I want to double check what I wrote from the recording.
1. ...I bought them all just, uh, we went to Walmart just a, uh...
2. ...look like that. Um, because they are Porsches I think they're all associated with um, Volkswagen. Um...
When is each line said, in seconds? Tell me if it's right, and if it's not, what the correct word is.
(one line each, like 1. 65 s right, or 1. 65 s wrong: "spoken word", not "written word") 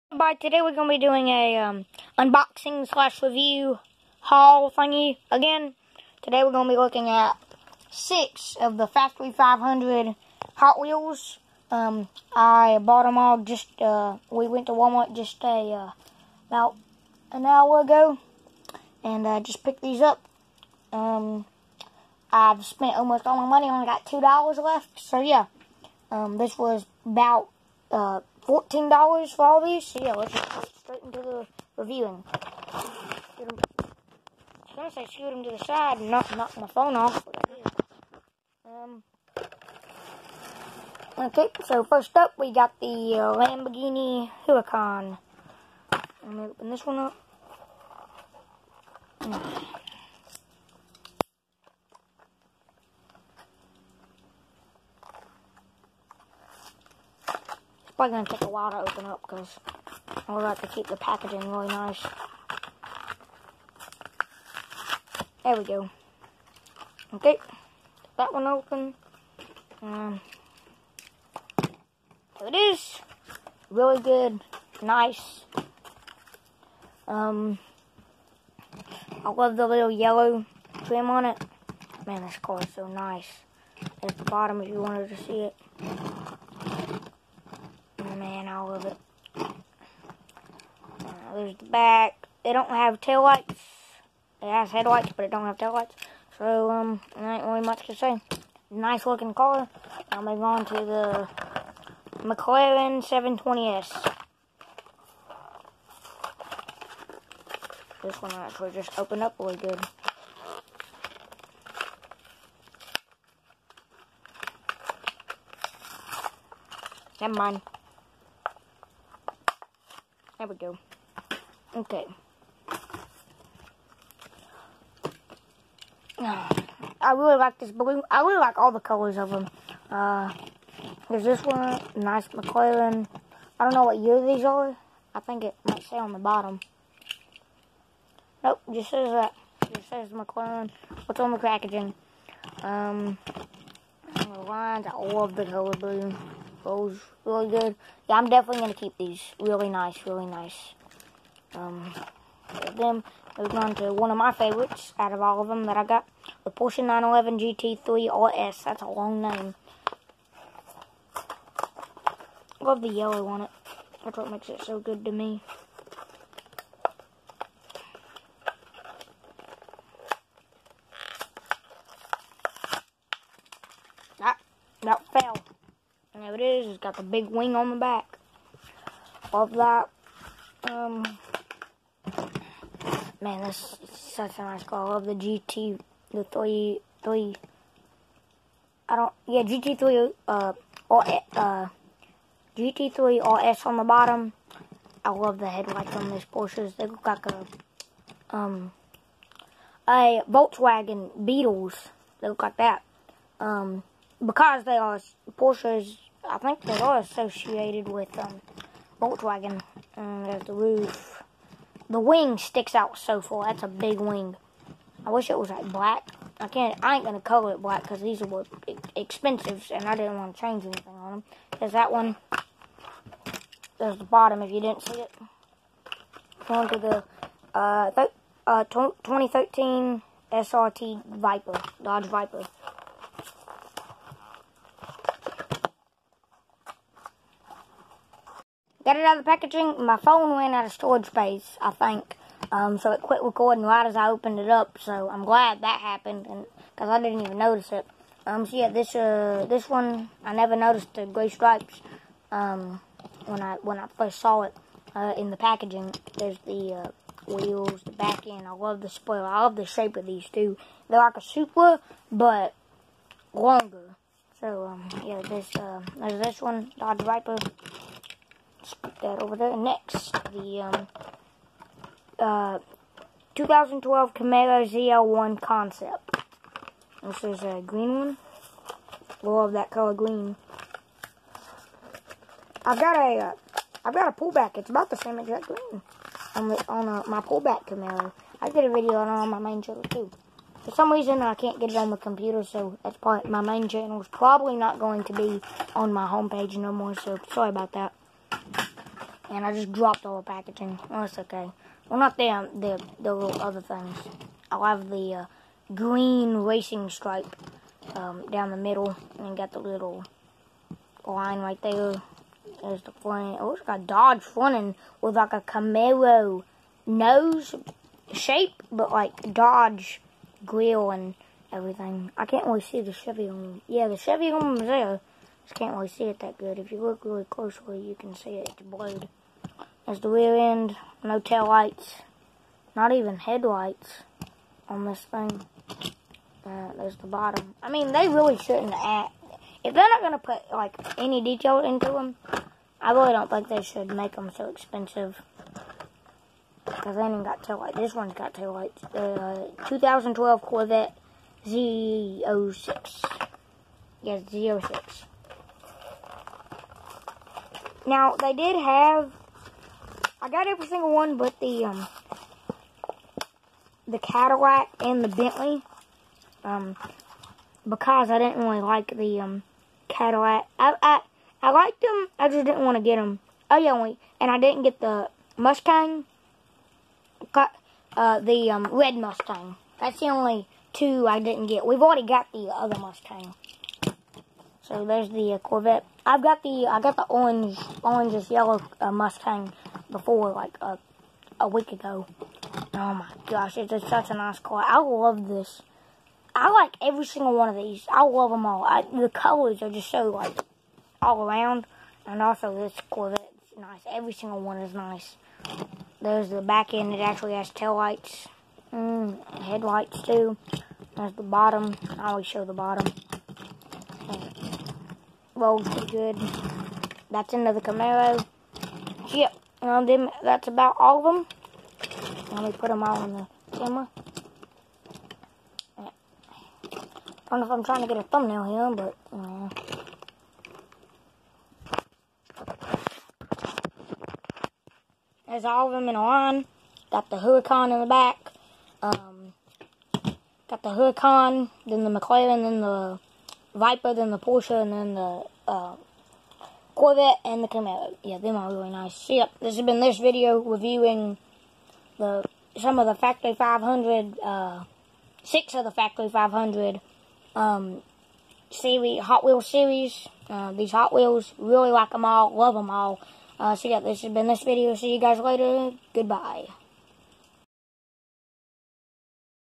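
1. 12 s right
2. 202 s right.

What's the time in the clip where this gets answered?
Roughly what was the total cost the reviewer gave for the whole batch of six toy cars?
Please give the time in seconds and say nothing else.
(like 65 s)
28 s.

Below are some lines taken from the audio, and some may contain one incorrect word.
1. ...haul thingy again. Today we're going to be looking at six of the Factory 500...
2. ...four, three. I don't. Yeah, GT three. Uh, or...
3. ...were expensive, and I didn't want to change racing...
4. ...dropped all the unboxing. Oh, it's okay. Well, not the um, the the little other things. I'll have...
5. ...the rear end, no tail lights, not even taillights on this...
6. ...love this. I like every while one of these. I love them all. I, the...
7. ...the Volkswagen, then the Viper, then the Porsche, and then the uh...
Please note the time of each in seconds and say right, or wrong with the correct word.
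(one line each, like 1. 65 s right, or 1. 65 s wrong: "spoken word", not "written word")
1. 4 s right
2. 186 s wrong: "three", not "four"
3. 218 s wrong: "anything", not "racing"
4. 299 s wrong: "packaging", not "unboxing"
5. 329 s wrong: "headlights", not "taillights"
6. 394 s wrong: "single", not "while"
7. 441 s wrong: "McLaren", not "Volkswagen".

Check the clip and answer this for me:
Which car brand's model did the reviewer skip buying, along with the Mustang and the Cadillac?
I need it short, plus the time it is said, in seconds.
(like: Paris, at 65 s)
Bentley, at 365 s.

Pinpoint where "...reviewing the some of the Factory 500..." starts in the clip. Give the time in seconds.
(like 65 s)
450 s.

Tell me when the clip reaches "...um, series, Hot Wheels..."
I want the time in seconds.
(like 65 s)
457 s.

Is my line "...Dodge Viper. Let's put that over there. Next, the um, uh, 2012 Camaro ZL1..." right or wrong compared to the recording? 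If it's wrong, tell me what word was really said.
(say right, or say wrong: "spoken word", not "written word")
right.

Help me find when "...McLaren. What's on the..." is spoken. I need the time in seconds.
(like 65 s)
140 s.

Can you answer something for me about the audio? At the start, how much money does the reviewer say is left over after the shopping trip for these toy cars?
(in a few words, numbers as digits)
$2.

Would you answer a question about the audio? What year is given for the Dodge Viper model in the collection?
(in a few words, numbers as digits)
2013.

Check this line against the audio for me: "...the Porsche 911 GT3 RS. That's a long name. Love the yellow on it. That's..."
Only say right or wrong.
right.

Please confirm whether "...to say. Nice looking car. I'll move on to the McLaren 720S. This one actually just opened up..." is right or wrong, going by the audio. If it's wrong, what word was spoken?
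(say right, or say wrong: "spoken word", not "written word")
right.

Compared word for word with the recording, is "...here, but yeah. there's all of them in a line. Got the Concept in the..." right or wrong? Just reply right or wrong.
wrong.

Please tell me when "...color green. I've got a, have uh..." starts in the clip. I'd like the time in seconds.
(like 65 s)
279 s.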